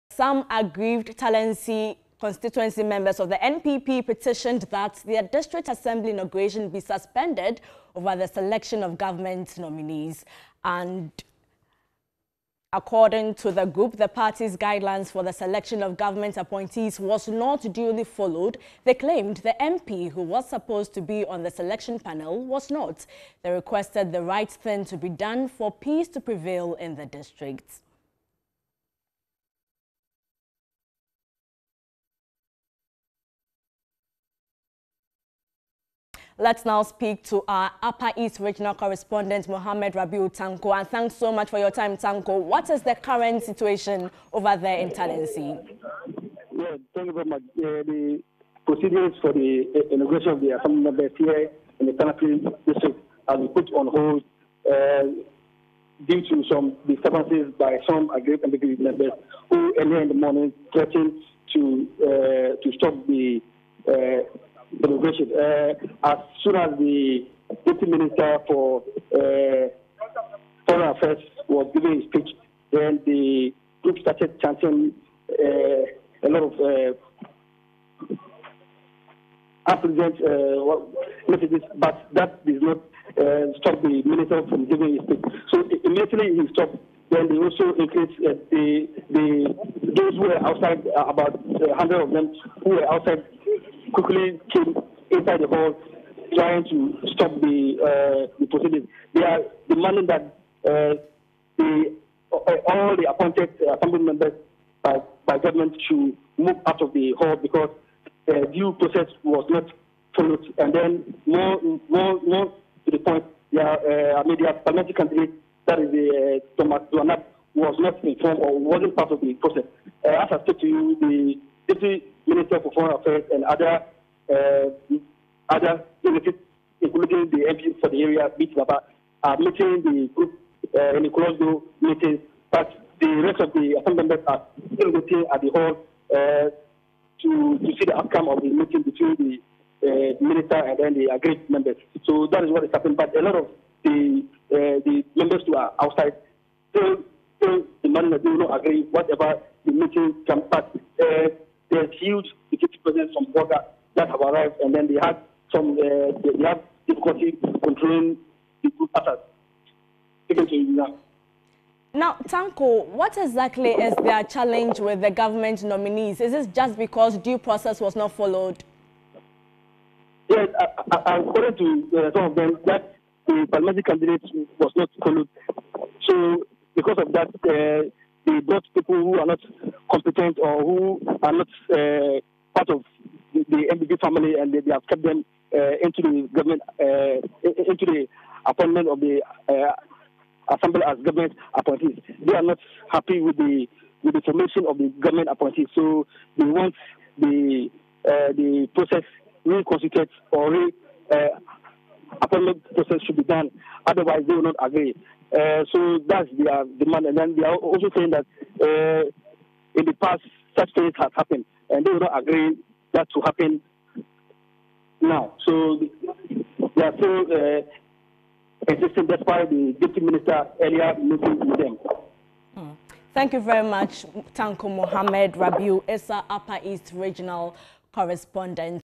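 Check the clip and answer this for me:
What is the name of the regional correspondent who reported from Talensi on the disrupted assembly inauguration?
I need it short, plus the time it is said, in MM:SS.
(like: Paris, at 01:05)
Mohammed Rabiu Tanko, at 00:39.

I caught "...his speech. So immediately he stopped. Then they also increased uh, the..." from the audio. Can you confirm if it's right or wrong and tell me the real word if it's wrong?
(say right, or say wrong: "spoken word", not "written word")
right.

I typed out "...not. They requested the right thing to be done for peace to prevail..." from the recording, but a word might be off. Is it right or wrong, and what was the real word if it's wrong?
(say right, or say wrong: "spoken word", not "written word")
right.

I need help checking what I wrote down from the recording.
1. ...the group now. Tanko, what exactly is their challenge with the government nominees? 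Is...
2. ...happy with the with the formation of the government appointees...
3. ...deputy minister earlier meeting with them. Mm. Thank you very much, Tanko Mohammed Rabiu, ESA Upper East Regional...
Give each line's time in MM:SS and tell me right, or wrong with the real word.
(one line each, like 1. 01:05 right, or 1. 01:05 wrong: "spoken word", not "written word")
1. 02:38 right
2. 03:12 right
3. 03:39 right.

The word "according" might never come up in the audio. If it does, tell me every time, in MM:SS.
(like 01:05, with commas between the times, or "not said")
00:12, 02:51.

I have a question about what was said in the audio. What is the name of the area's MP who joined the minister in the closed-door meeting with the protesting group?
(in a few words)
Mr. Baba.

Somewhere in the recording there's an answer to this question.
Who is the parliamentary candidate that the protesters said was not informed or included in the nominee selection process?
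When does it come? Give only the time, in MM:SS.
01:56.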